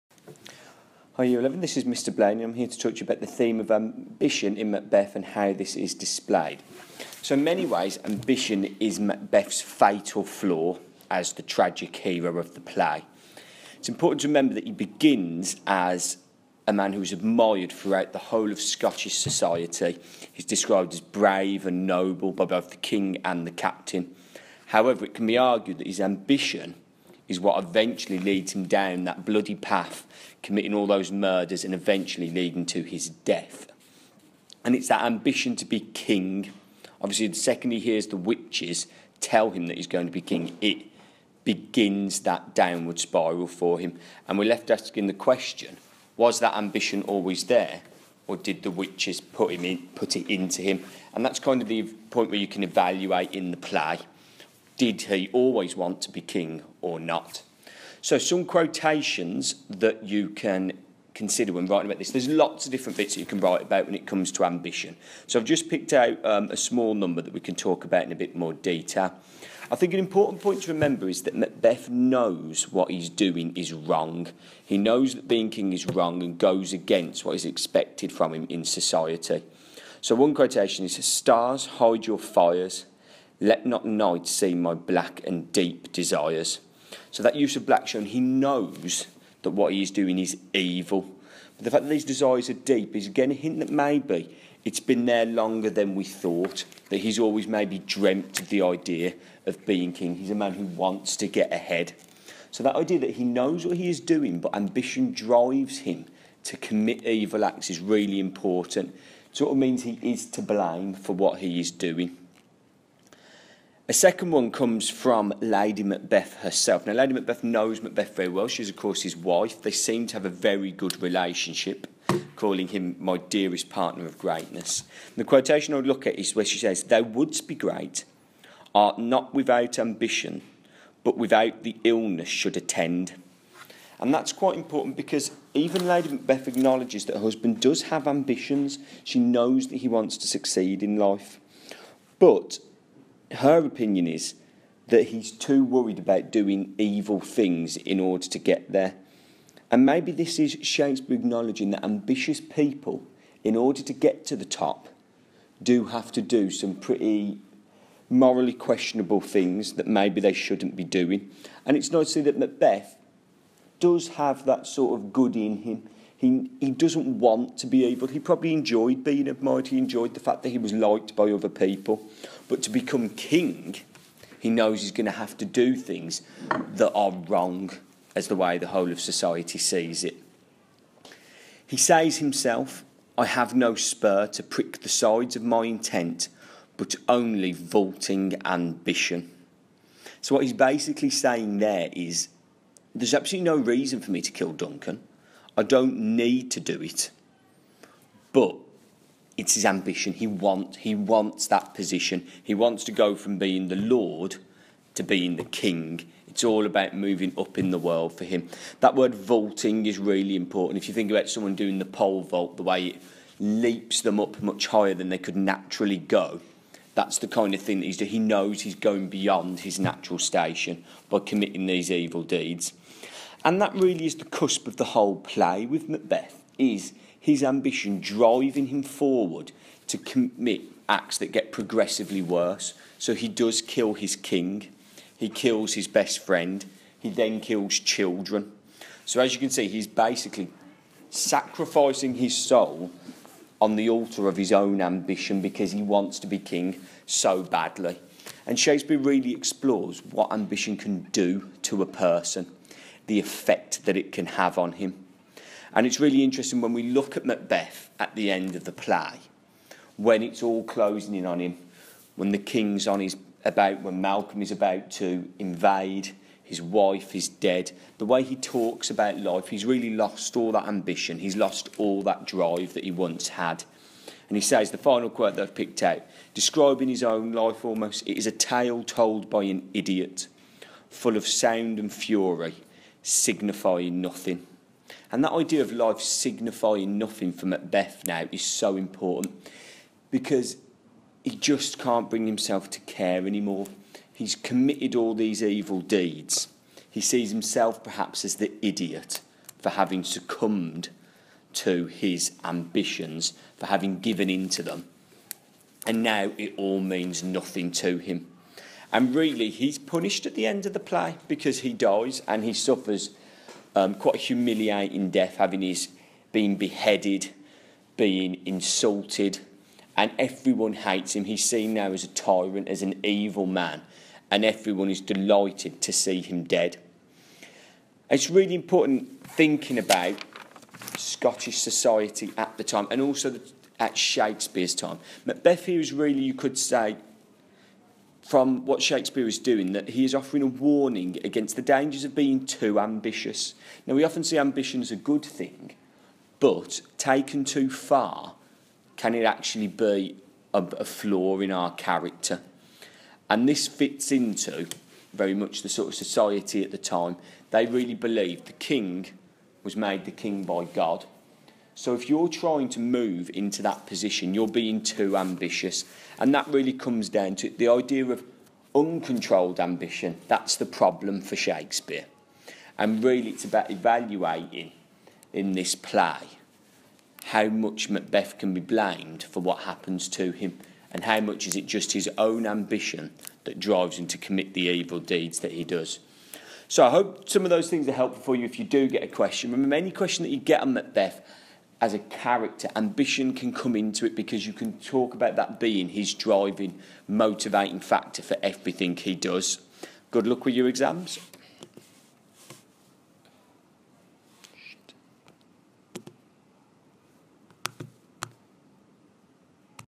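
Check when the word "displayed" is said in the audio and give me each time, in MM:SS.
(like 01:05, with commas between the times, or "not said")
00:05.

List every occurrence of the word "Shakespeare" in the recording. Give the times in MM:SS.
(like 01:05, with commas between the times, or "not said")
02:30, 04:08, 05:33, 05:38, 06:11.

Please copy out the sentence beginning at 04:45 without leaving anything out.
And that idea of life signifying nothing for Macbeth now is so important because he just can't bring himself to care anymore.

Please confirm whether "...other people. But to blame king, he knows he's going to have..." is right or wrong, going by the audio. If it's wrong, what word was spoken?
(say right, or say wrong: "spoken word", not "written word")
wrong: "become", not "blame".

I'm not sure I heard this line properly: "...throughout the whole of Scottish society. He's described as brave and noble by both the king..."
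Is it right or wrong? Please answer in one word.
right.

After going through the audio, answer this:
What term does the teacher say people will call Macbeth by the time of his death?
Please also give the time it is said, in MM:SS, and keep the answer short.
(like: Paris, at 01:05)
tyrant, at 05:22.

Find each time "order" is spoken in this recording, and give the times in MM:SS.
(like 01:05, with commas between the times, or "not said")
02:27, 02:33.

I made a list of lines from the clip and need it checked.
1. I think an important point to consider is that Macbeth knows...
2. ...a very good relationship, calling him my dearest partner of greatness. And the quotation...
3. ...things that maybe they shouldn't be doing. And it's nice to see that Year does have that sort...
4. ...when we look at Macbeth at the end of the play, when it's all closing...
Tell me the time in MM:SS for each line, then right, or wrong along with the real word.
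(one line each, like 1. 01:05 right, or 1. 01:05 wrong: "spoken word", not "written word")
1. 01:09 wrong: "remember", not "consider"
2. 02:00 right
3. 02:39 wrong: "Macbeth", not "Year"
4. 04:16 right.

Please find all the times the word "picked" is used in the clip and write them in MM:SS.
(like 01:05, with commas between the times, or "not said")
01:05, 04:35.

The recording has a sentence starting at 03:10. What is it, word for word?
So, what he's basically saying there is there's absolutely no reason for me to kill Duncan.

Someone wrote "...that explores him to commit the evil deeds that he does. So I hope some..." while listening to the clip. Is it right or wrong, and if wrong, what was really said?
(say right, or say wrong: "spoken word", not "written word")
wrong: "drives", not "explores".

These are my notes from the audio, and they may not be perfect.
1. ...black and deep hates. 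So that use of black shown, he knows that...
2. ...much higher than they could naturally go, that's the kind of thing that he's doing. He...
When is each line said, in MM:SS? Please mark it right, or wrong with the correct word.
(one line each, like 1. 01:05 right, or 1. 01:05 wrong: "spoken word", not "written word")
1. 01:24 wrong: "desires", not "hates"
2. 03:34 right.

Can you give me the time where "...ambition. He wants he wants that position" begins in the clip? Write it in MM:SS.
03:19.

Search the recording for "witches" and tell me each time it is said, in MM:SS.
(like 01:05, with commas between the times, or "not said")
00:38, 00:48.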